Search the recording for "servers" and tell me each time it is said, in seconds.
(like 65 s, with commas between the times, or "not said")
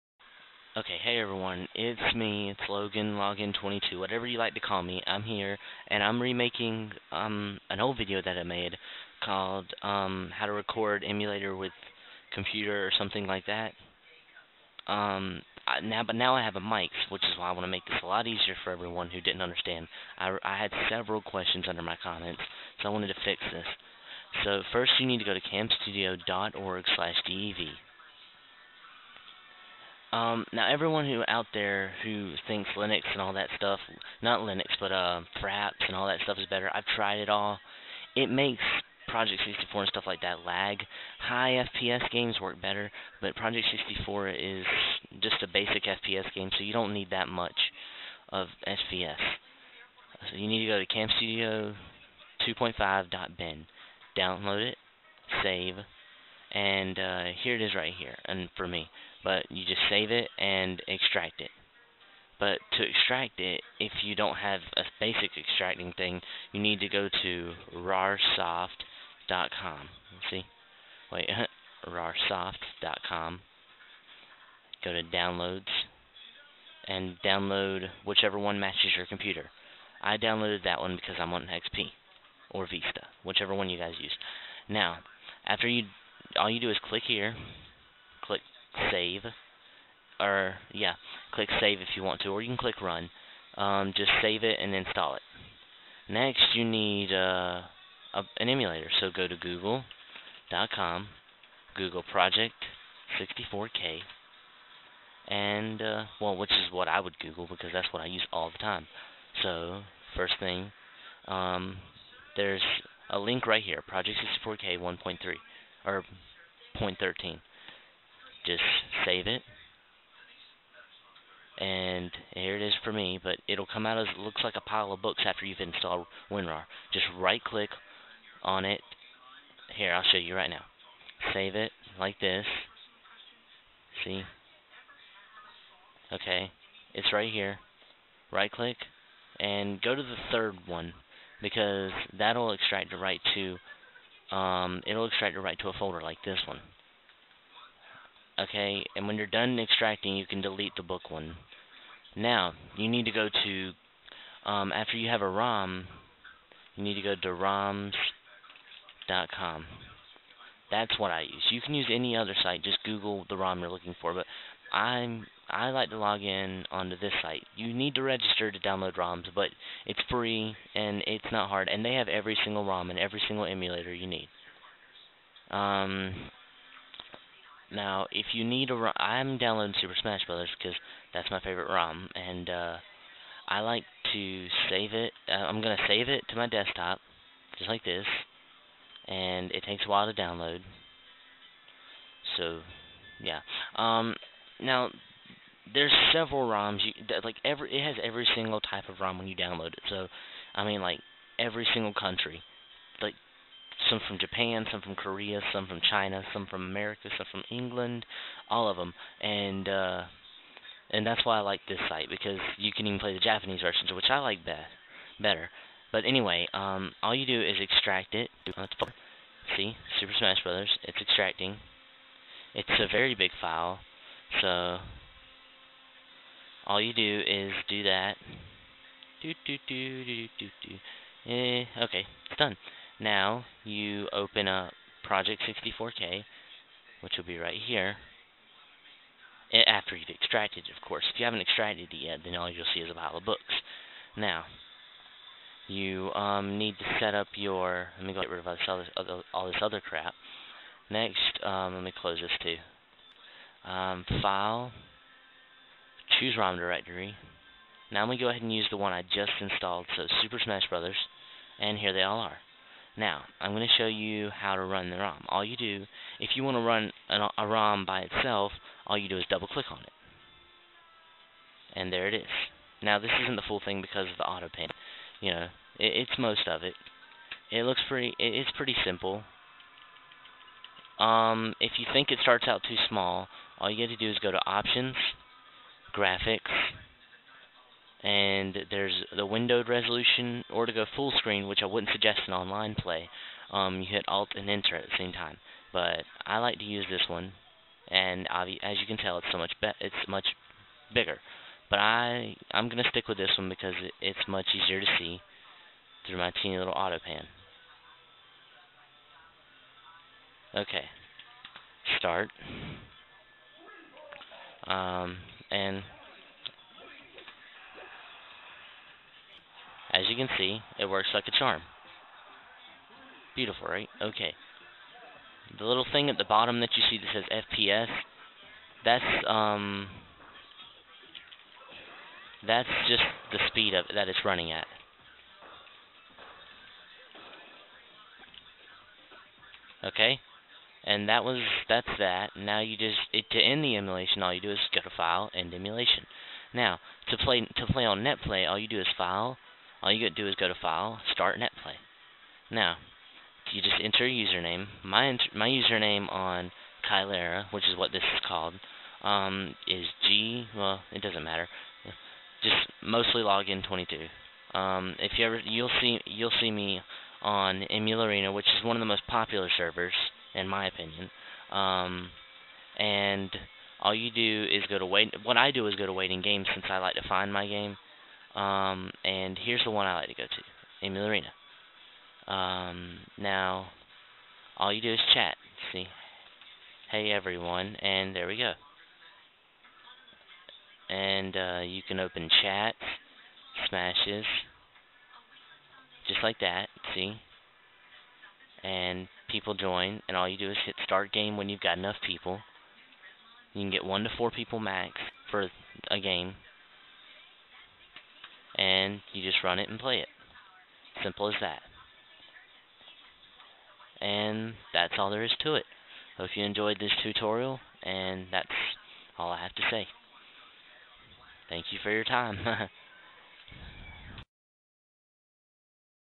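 369 s.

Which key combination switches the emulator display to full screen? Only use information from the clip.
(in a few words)
Alt and Enter.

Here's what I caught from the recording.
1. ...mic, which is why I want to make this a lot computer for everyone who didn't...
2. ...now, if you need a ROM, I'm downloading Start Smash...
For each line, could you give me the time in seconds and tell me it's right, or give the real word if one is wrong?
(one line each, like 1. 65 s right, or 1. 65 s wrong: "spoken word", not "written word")
1. 16 s wrong: "easier", not "computer"
2. 177 s wrong: "Super", not "Start".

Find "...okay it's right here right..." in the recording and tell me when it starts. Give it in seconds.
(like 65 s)
136 s.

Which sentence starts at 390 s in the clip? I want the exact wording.
And uh, you can open chat, smashes, just like that.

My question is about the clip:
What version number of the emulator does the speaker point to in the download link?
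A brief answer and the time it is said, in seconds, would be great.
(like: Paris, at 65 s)
0.13, at 116 s.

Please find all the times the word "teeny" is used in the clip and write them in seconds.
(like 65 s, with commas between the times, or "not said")
306 s.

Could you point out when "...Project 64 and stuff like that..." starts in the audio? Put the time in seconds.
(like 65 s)
39 s.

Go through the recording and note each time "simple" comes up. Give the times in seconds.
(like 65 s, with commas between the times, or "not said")
278 s, 411 s.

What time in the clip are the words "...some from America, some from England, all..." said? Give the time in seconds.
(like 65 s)
206 s.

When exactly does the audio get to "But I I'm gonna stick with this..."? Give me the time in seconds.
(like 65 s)
301 s.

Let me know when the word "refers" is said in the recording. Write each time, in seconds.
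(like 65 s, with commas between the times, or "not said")
not said.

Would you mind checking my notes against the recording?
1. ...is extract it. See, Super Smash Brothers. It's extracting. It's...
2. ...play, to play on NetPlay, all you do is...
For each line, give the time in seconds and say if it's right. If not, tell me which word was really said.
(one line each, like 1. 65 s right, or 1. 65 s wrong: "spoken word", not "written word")
1. 217 s right
2. 347 s right.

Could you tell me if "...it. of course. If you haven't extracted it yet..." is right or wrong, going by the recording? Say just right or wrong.
right.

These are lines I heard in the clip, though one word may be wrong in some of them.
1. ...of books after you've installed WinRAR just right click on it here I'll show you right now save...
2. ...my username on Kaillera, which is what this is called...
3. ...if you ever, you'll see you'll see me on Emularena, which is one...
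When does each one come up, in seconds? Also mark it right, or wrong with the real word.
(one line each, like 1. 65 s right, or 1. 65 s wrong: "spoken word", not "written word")
1. 124 s right
2. 355 s right
3. 364 s right.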